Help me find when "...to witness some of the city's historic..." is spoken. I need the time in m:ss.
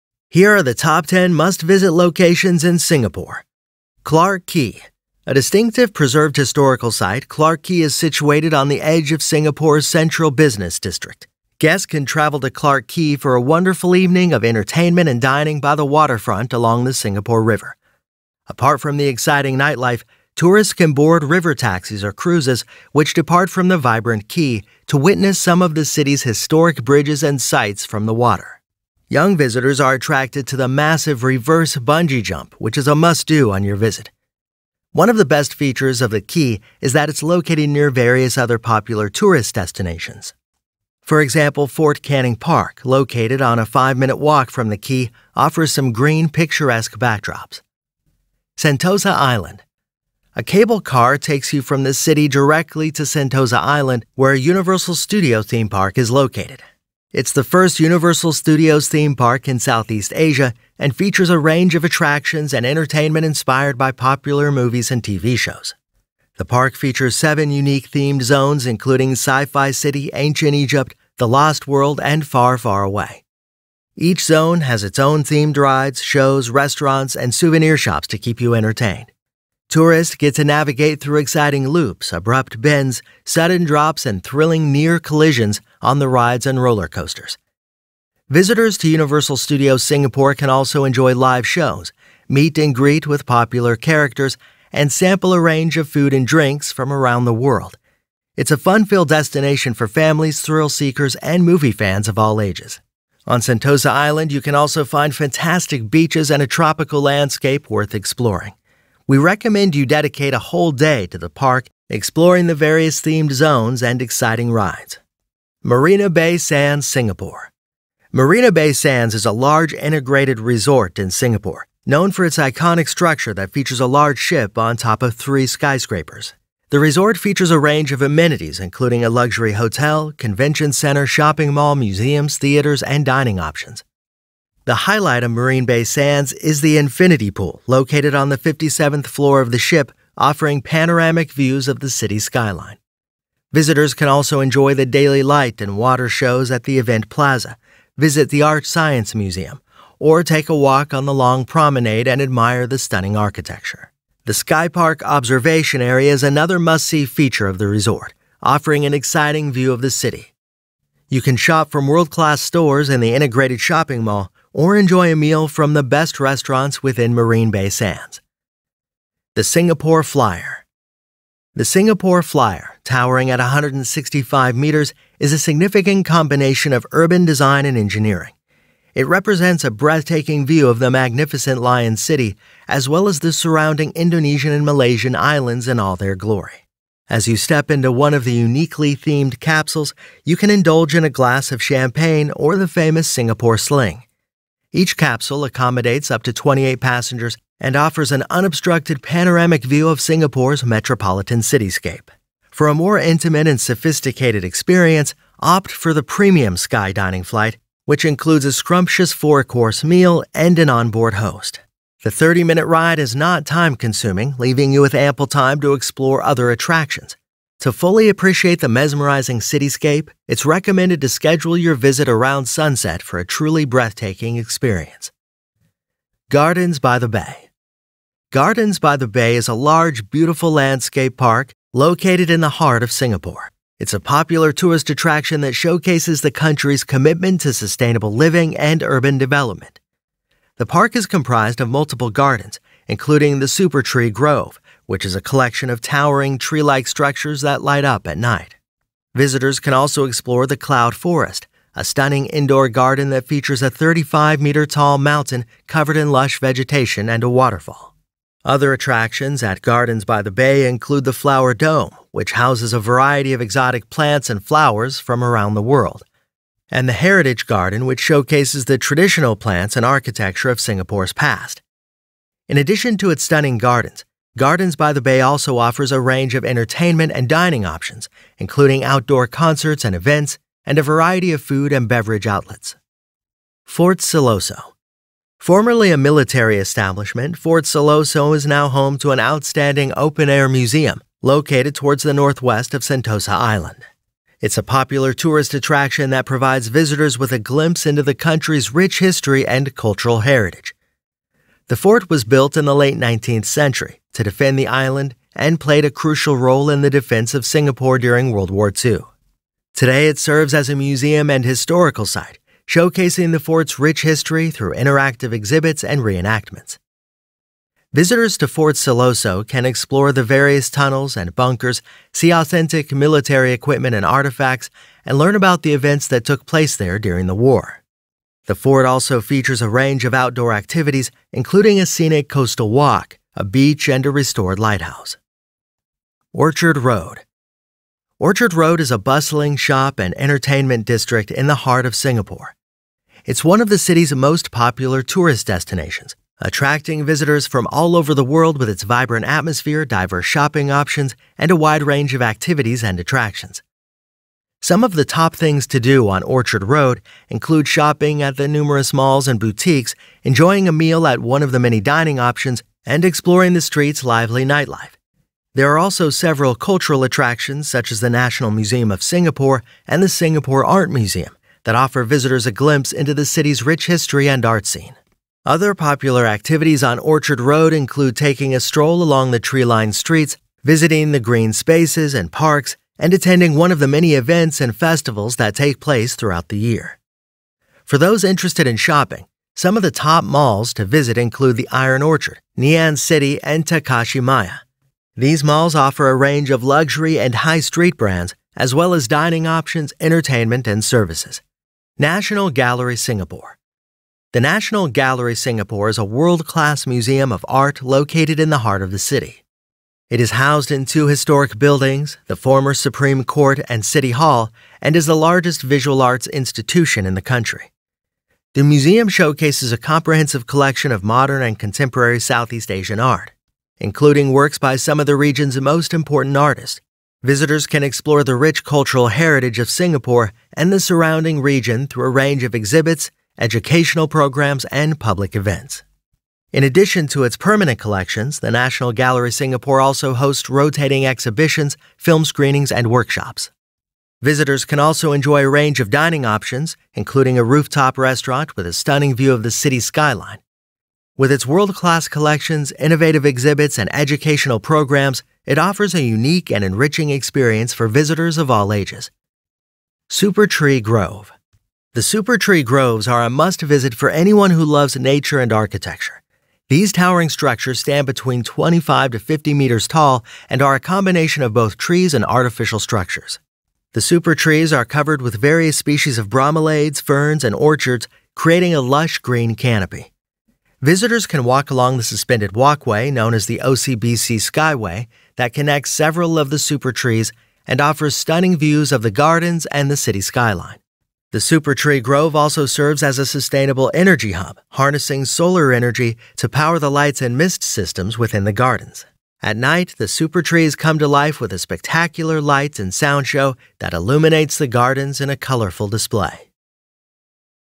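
0:24.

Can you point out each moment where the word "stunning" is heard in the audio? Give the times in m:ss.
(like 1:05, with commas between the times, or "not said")
2:32, 4:11, 4:33, 7:28, 8:08.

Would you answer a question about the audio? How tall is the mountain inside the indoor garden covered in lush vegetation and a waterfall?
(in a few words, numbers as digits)
35 meters.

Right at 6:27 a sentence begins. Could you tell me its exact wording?
For those interested in shopping, some of the top malls to visit include the ION Orchard, Ngee Ann City, and Takashimaya.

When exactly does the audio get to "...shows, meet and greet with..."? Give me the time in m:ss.
1:31.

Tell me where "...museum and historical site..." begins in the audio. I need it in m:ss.
5:10.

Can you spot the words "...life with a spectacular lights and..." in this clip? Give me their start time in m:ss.
8:21.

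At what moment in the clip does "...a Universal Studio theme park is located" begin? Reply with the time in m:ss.
0:54.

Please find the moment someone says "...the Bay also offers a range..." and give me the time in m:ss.
4:34.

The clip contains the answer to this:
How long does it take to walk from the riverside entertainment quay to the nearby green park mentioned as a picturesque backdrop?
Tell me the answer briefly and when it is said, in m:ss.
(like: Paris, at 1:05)
5 minutes, at 0:43.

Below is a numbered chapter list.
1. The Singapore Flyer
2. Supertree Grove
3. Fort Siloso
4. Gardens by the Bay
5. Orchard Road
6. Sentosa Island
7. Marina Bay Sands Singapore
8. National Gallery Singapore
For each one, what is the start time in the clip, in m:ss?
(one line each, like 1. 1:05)
1. 2:49
2. 7:40
3. 4:44
4. 3:46
5. 5:36
6. 0:49
7. 1:56
8. 6:42.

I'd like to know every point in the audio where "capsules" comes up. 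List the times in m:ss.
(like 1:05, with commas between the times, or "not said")
3:09, 3:14.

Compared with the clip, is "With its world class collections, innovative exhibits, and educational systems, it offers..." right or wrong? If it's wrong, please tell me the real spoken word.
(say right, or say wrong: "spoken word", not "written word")
wrong: "programs", not "systems".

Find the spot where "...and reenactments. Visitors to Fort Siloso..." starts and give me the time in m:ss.
5:15.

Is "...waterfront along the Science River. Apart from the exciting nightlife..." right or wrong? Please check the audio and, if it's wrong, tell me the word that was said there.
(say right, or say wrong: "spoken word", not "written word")
wrong: "Singapore", not "Science".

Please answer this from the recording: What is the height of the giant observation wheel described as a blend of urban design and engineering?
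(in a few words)
165 meters.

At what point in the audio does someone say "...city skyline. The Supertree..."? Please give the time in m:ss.
8:09.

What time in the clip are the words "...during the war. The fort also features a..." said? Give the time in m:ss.
5:26.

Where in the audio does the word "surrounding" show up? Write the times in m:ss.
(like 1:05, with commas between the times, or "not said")
3:03, 7:10.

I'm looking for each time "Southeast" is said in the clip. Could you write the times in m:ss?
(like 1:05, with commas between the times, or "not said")
0:59, 7:02.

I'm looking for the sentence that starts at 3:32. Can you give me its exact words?
The 30 minute ride is not time consuming, leaving you with ample time to explore other attractions.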